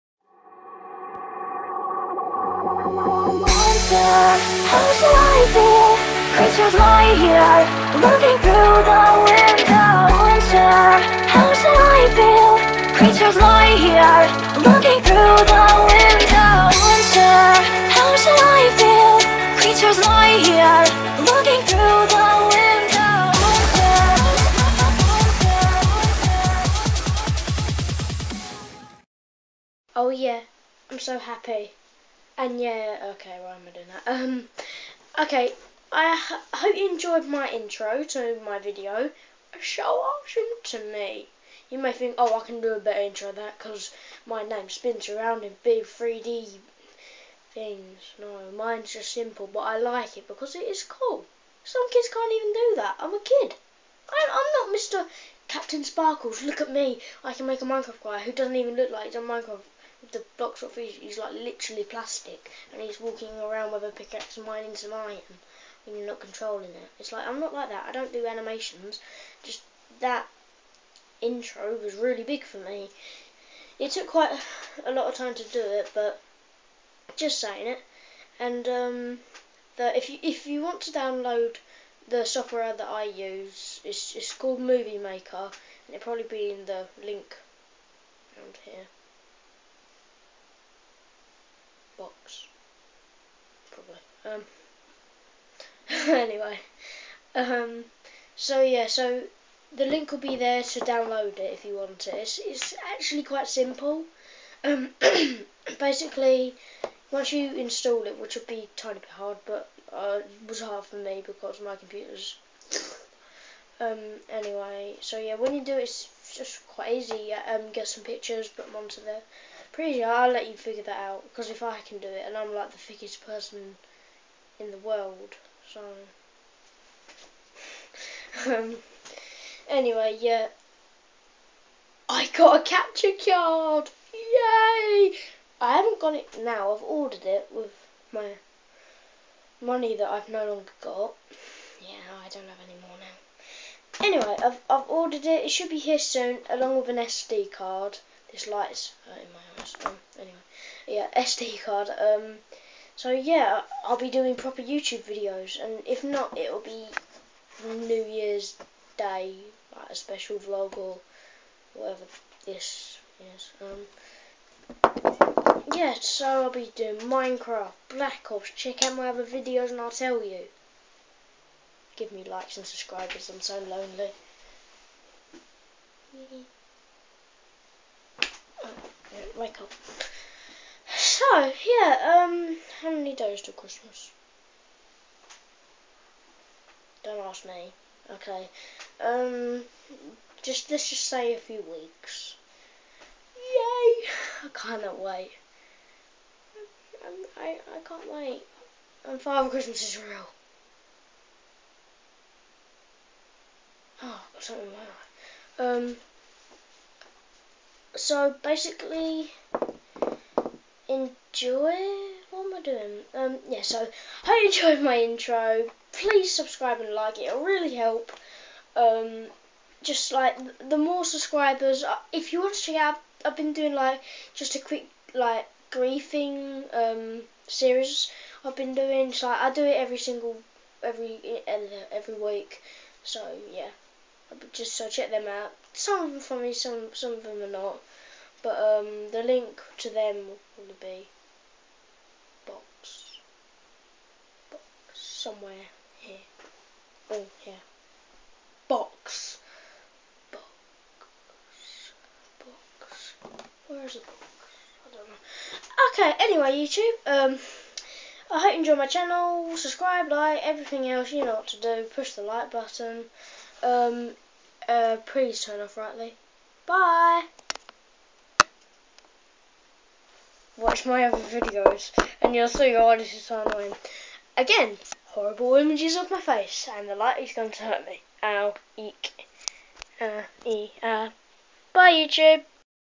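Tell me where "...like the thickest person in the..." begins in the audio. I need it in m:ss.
2:02.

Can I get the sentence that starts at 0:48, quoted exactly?
No, mine's just simple, but I like it because it is cool.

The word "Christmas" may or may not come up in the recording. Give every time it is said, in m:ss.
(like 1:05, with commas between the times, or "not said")
3:03, 3:19.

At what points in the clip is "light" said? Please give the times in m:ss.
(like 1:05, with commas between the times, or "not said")
2:28, 4:36.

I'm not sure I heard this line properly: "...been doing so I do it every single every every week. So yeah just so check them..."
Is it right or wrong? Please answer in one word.
right.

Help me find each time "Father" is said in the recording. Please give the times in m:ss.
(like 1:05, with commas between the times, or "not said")
3:19.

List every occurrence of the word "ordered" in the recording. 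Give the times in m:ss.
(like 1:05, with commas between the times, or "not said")
2:16, 2:24.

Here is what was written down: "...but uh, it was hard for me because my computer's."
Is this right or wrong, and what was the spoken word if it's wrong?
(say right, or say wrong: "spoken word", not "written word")
right.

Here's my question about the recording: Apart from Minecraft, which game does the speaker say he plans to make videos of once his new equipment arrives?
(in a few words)
Black Ops.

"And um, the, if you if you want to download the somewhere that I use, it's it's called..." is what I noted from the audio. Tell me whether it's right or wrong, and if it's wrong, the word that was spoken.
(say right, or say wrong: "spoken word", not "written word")
wrong: "software", not "somewhere".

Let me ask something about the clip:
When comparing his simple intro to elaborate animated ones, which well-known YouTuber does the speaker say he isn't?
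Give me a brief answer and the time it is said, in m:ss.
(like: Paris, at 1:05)
CaptainSparklez, at 0:54.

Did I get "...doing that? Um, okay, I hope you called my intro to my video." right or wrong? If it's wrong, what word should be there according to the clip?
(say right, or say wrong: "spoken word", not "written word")
wrong: "enjoyed", not "called".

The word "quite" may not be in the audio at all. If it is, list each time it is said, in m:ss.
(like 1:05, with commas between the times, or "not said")
1:14, 1:43, 1:56.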